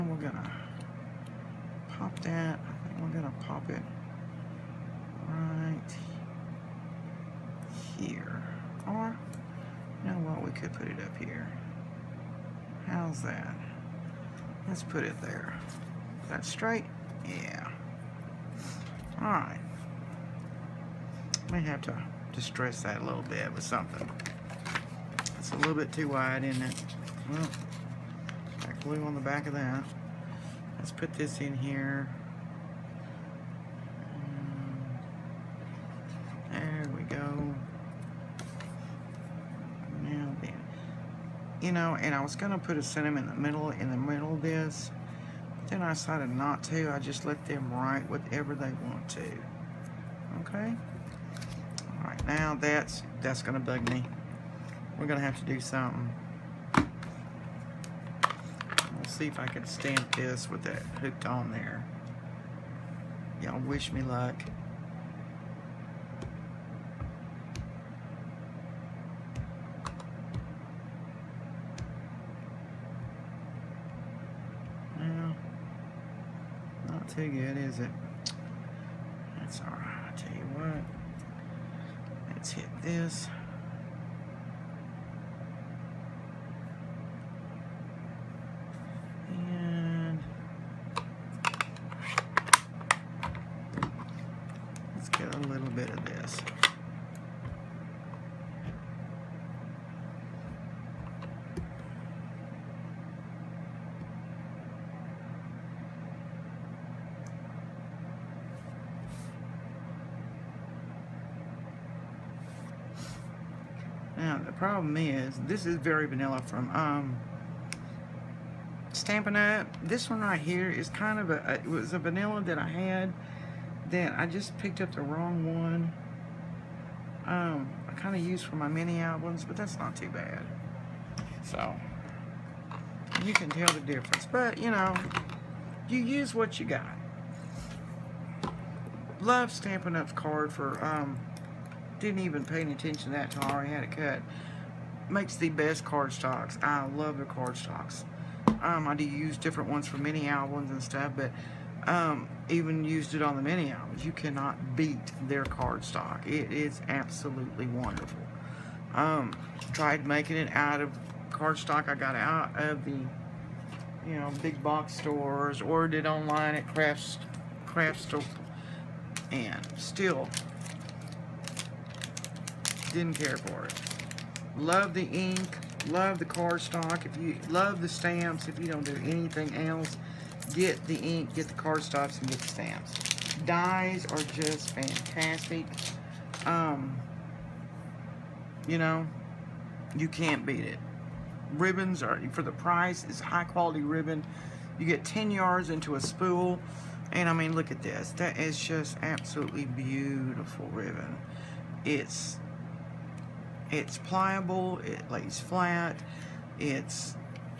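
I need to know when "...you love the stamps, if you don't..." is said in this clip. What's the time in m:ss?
2:57.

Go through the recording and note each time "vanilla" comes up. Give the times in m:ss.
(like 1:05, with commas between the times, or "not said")
1:56, 2:01.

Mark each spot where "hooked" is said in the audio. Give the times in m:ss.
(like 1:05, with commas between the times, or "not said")
1:01.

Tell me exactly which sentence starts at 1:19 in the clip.
That's alright, I tell you what.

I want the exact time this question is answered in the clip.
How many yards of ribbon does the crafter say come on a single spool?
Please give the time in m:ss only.
3:15.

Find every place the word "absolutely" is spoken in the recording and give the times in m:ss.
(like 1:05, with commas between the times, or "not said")
2:36, 3:19.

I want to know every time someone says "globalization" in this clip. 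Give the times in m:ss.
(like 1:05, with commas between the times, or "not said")
not said.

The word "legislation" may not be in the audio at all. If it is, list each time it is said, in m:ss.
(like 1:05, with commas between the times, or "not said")
not said.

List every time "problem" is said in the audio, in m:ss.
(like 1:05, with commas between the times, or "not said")
1:54.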